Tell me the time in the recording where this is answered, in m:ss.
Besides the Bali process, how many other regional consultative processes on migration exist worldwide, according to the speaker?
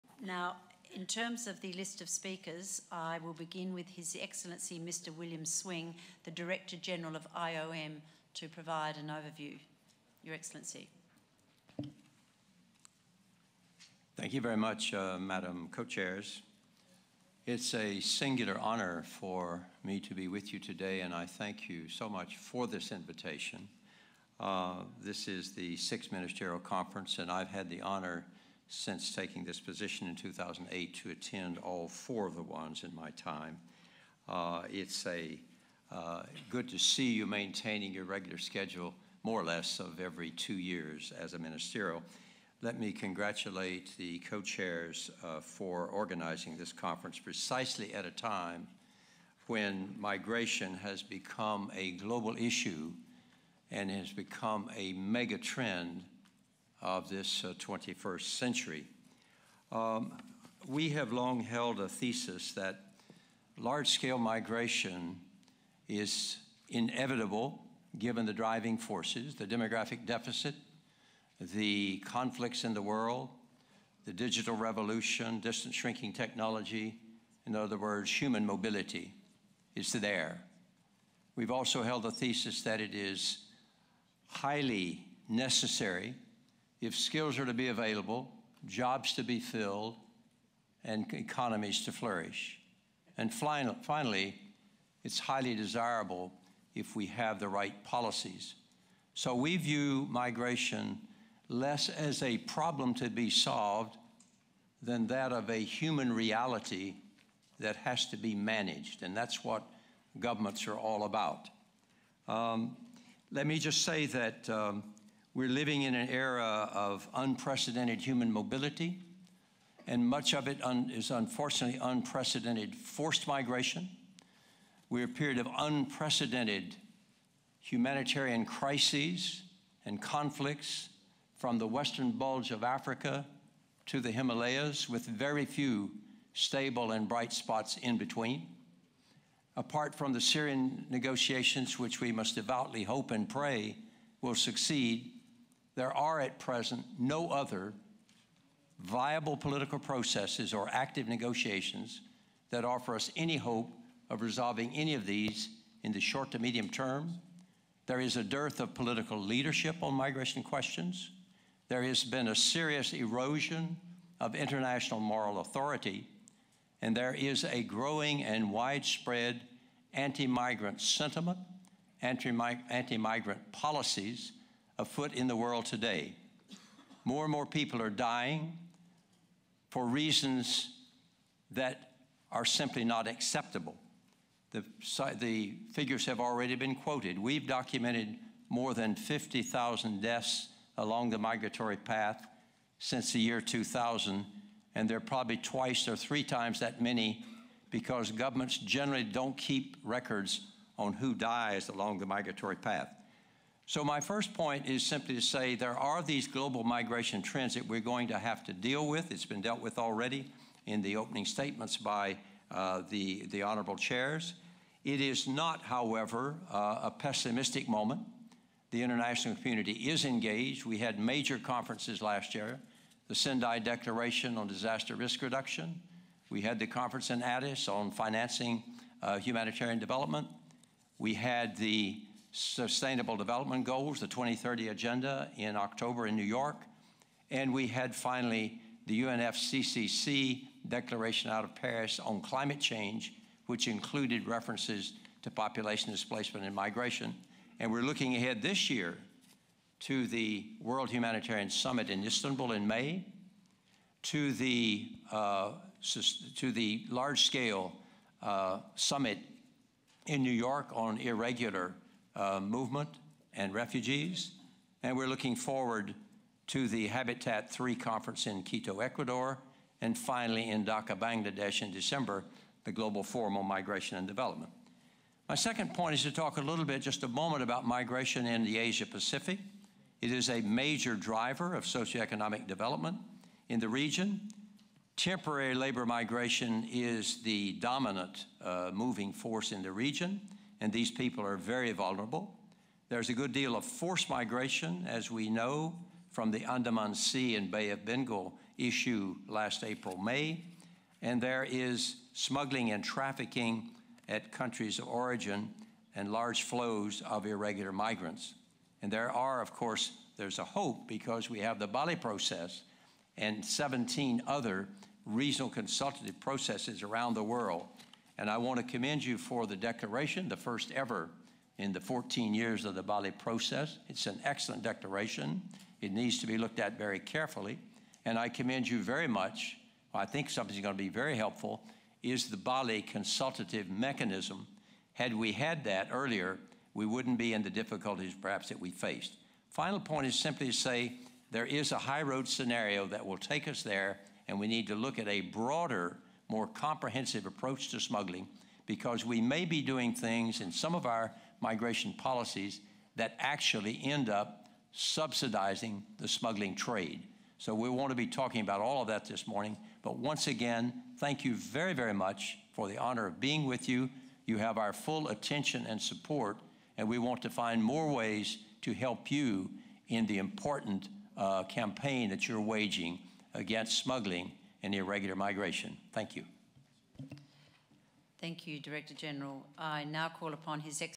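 5:13.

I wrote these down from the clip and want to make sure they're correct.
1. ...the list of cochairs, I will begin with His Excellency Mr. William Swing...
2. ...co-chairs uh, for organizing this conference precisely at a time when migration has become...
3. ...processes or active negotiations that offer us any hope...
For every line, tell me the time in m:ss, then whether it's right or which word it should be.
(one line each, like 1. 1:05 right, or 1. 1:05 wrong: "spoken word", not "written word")
1. 0:01 wrong: "speakers", not "cochairs"
2. 0:44 right
3. 2:29 right.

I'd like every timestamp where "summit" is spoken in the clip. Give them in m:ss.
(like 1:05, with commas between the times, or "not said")
4:11, 4:18.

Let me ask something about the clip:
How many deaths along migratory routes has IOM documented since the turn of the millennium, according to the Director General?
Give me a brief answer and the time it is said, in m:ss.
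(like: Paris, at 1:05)
50,000, at 3:08.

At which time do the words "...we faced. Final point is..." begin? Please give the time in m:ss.
5:38.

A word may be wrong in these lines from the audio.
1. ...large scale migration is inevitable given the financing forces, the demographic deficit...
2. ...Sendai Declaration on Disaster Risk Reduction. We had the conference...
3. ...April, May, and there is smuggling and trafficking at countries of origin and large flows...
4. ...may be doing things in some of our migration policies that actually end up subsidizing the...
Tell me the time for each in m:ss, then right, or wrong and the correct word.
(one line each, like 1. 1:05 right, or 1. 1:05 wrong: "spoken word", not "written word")
1. 1:03 wrong: "driving", not "financing"
2. 3:43 right
3. 4:59 right
4. 5:49 right.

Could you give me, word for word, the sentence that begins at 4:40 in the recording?
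It is a major driver of socioeconomic development in the region.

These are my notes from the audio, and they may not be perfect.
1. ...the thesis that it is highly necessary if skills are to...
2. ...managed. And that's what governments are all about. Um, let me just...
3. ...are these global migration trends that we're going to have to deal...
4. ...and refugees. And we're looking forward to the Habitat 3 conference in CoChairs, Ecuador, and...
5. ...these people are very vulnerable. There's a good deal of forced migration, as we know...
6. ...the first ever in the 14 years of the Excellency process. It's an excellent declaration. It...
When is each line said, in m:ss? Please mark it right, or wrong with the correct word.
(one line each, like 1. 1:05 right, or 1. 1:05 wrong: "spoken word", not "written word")
1. 1:22 right
2. 1:48 right
3. 3:25 right
4. 4:23 wrong: "Quito", not "CoChairs"
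5. 4:50 right
6. 5:20 wrong: "Bali", not "Excellency".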